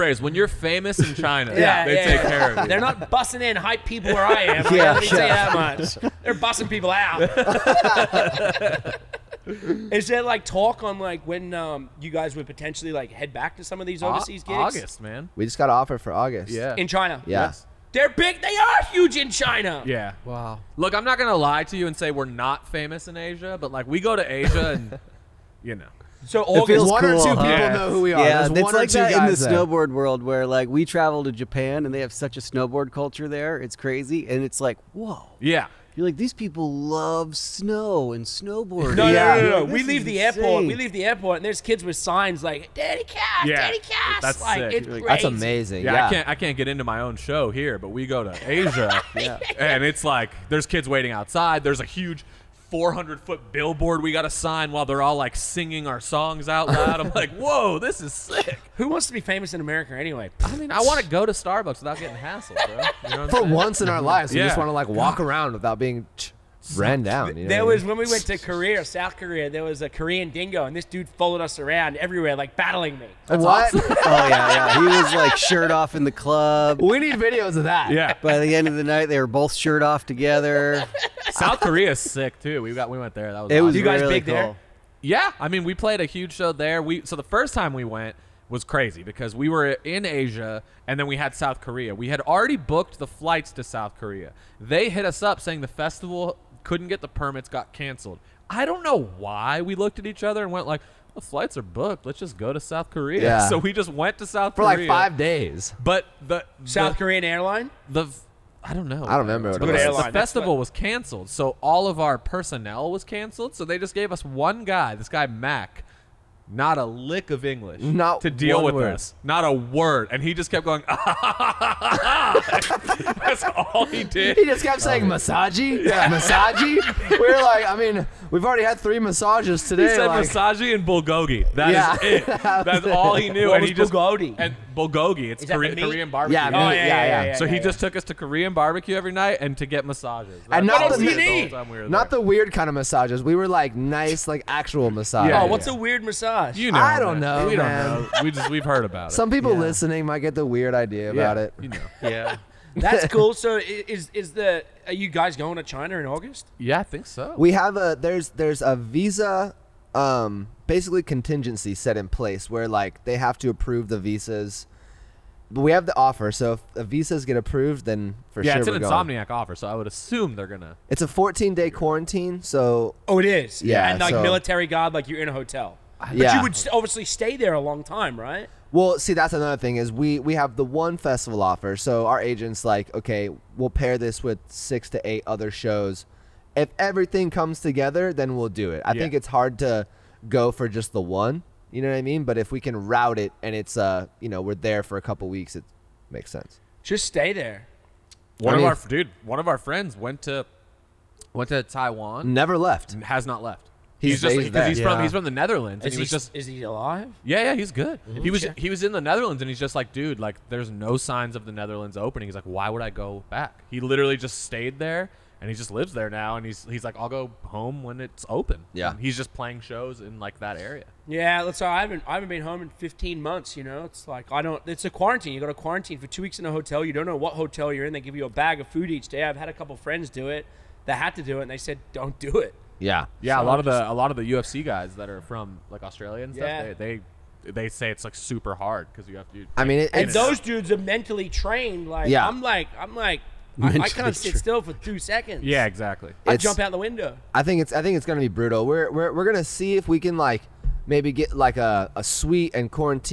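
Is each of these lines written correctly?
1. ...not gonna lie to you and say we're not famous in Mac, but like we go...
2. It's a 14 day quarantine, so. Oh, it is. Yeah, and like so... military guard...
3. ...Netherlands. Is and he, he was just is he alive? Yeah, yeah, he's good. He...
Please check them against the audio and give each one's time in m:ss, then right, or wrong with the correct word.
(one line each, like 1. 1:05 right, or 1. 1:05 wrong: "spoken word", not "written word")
1. 0:21 wrong: "Asia", not "Mac"
2. 2:50 right
3. 3:25 right.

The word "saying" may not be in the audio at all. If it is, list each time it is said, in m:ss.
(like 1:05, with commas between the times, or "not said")
1:03, 1:35, 2:04.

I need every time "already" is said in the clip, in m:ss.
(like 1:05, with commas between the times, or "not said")
1:32, 2:08.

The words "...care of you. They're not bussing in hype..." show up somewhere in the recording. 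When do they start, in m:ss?
0:02.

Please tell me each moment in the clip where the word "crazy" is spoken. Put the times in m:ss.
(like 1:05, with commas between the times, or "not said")
0:33, 1:28.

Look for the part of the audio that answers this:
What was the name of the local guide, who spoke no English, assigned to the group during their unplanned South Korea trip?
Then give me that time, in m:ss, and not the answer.
1:55.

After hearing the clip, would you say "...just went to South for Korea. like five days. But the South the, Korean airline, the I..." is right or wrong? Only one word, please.
right.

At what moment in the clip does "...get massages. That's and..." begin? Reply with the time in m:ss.
2:19.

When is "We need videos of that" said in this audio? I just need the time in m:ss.
1:16.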